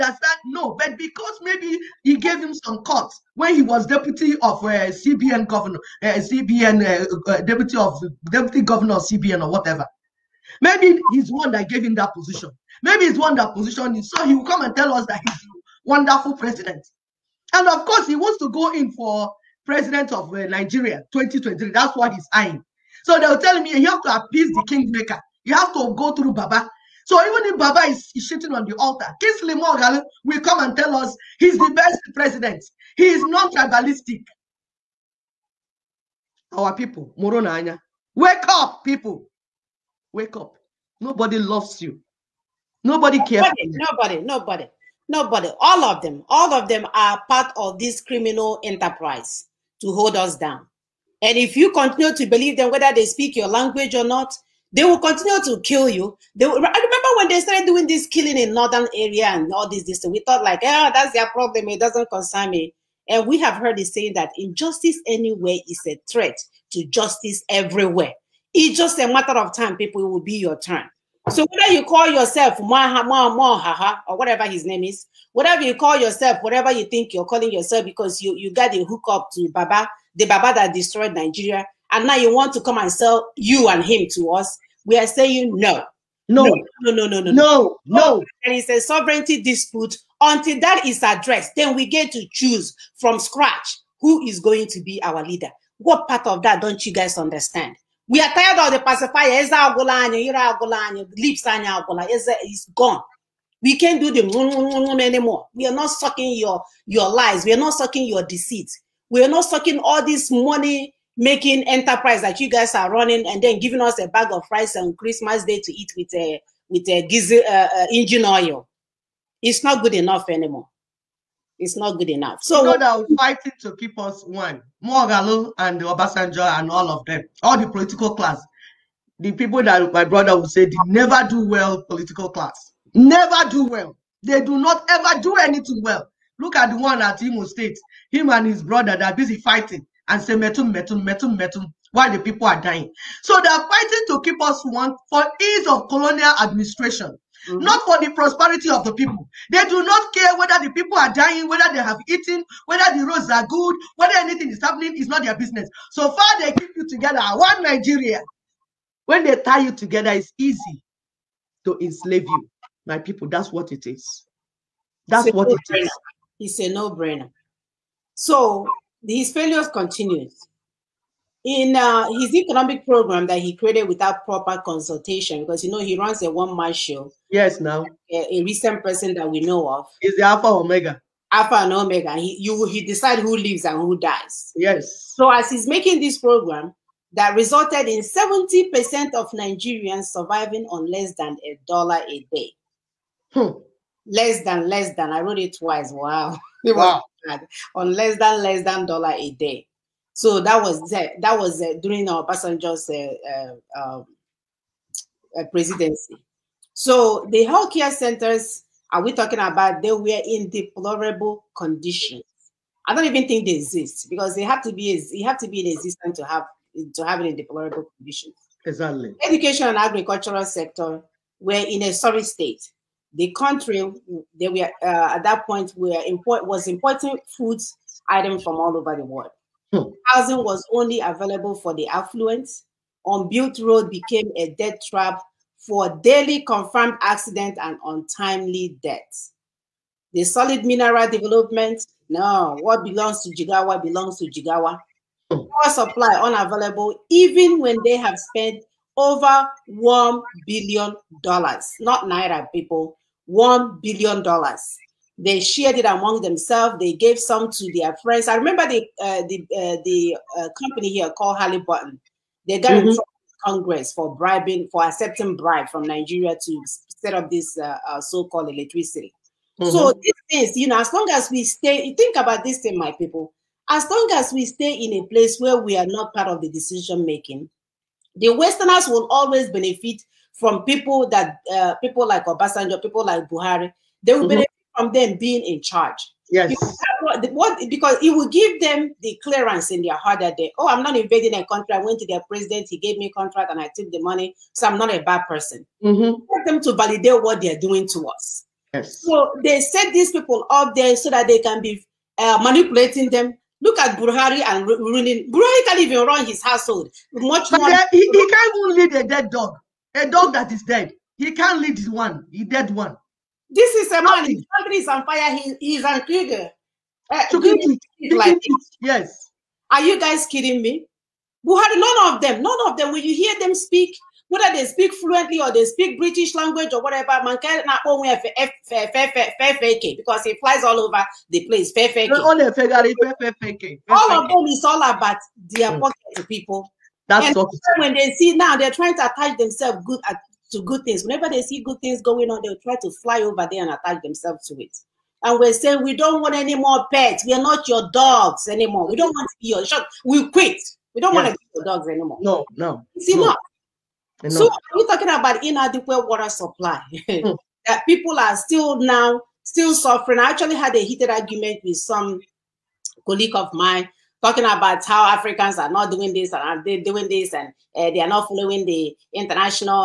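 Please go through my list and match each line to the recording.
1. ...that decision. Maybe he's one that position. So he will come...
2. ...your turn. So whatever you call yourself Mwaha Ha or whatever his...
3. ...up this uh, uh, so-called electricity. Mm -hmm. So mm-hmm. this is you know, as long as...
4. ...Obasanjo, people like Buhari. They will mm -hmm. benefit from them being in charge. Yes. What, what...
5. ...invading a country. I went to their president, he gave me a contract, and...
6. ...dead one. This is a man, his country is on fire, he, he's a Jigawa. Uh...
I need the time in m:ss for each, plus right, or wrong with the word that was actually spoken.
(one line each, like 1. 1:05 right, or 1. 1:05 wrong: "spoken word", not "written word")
1. 0:11 wrong: "position", not "decision"
2. 1:10 wrong: "whether", not "whatever"
3. 4:27 right
4. 4:42 right
5. 4:50 right
6. 5:12 wrong: "Krieger", not "Jigawa".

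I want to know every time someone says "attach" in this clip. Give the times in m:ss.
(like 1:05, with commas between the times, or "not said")
5:39, 5:43.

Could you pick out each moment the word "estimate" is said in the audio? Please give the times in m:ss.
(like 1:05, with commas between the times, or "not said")
not said.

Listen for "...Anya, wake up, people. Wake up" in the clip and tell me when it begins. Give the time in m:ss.
0:37.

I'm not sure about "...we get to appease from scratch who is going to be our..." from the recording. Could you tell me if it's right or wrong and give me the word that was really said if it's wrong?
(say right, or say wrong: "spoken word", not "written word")
wrong: "choose", not "appease".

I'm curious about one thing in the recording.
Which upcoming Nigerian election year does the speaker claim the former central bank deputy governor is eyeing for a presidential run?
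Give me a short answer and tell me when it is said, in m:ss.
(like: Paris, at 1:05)
2023, at 0:21.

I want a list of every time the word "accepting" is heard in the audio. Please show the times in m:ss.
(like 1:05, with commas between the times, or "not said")
4:24.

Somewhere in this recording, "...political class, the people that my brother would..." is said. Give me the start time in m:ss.
2:07.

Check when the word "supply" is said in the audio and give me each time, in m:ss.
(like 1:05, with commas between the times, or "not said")
4:05, 5:56.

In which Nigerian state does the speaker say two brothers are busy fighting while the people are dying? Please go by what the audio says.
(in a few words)
Imo State.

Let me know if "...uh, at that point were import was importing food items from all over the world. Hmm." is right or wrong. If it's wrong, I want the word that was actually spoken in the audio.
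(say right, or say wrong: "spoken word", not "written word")
right.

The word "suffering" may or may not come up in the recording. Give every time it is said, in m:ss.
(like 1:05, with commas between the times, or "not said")
5:59.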